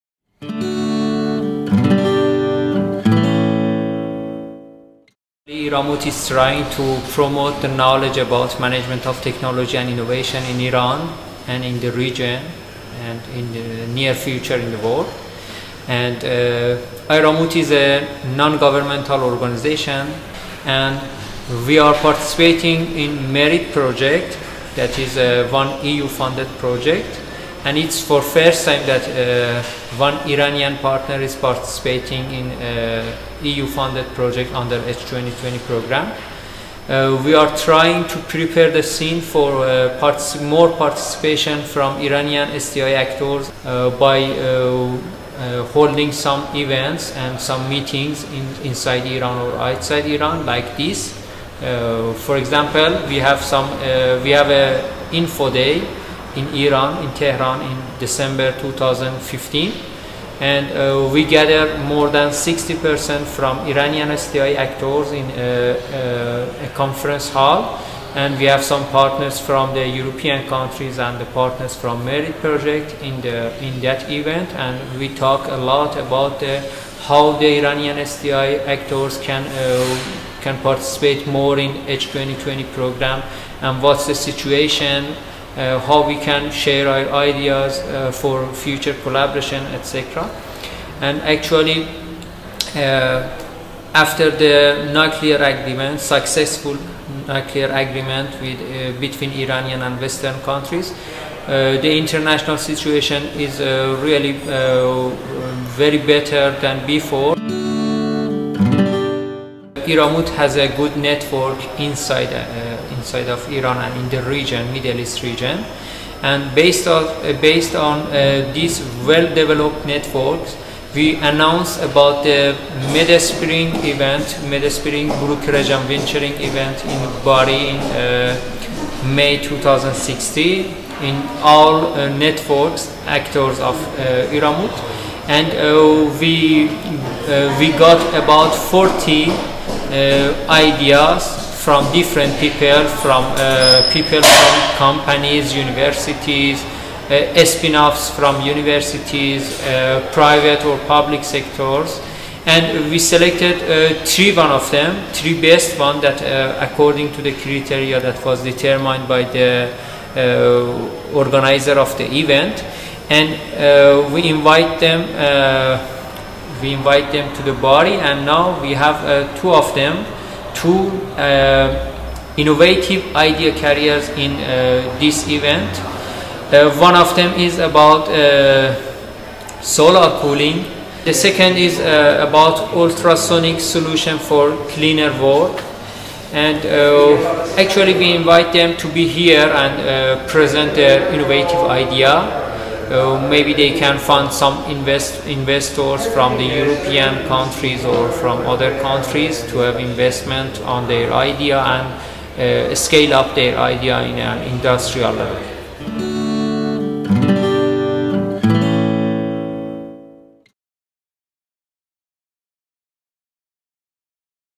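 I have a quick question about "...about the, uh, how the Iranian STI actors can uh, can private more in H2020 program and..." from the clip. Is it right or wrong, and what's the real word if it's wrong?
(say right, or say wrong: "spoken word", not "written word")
wrong: "participate", not "private".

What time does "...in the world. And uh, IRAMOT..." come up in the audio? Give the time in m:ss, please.
0:14.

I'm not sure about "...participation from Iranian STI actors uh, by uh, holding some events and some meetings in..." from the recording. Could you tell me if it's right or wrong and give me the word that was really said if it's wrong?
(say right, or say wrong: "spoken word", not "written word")
right.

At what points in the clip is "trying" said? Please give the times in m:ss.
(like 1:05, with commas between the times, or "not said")
0:06, 0:37.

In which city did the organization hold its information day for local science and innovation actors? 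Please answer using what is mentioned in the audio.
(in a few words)
Tehran.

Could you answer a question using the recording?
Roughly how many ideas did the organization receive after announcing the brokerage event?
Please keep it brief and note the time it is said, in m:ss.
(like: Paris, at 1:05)
40, at 2:18.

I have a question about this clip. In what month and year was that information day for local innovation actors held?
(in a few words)
December 2015.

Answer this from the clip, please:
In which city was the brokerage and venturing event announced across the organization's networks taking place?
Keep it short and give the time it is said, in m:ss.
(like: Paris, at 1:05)
Bari, at 2:07.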